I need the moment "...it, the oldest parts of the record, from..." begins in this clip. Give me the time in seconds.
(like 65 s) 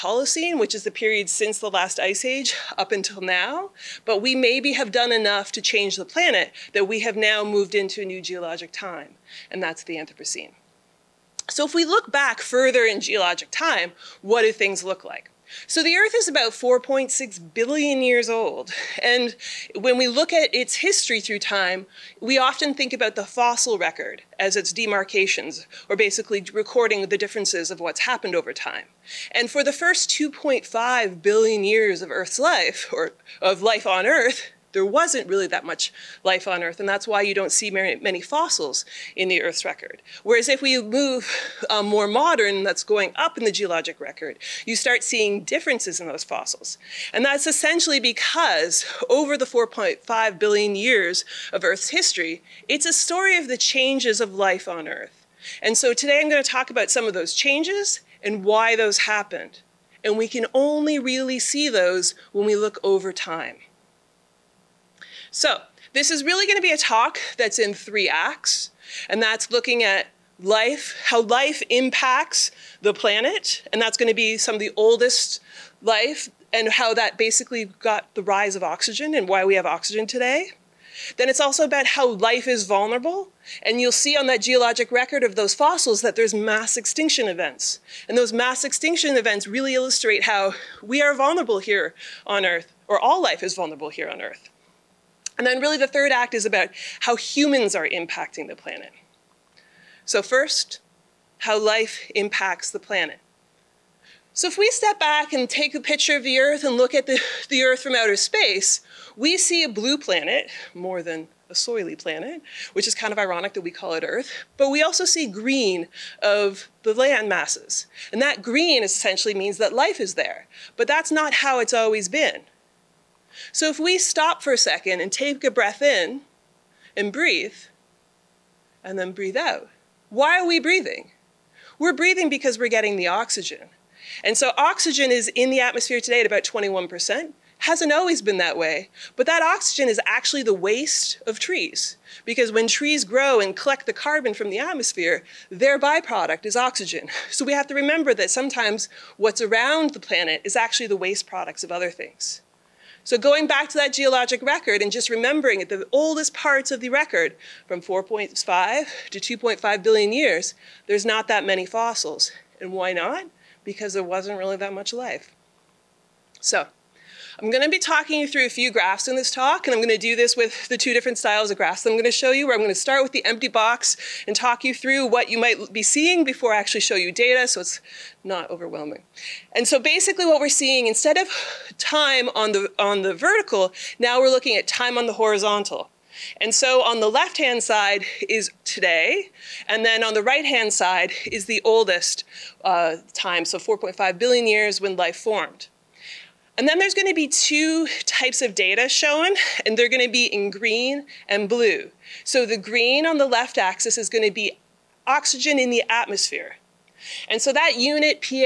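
155 s.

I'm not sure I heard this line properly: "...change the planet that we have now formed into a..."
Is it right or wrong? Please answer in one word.
wrong.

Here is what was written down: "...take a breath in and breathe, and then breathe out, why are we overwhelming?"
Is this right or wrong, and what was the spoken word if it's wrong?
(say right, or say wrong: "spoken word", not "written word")
wrong: "breathing", not "overwhelming".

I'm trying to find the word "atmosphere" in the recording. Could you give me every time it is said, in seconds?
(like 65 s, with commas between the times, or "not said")
135 s, 144 s, 205 s.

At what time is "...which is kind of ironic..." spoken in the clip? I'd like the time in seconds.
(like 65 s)
112 s.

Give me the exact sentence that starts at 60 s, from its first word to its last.
And we can only really see those when we look over time.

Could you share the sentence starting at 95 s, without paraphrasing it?
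And then really the third act is about how humans are impacting the planet.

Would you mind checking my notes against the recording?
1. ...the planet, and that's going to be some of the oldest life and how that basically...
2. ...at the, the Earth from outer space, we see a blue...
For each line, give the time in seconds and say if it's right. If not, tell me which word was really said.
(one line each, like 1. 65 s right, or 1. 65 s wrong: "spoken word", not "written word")
1. 72 s right
2. 106 s right.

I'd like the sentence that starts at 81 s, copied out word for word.
Then it's also about how life is vulnerable.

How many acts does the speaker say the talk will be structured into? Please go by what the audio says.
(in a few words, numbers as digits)
3.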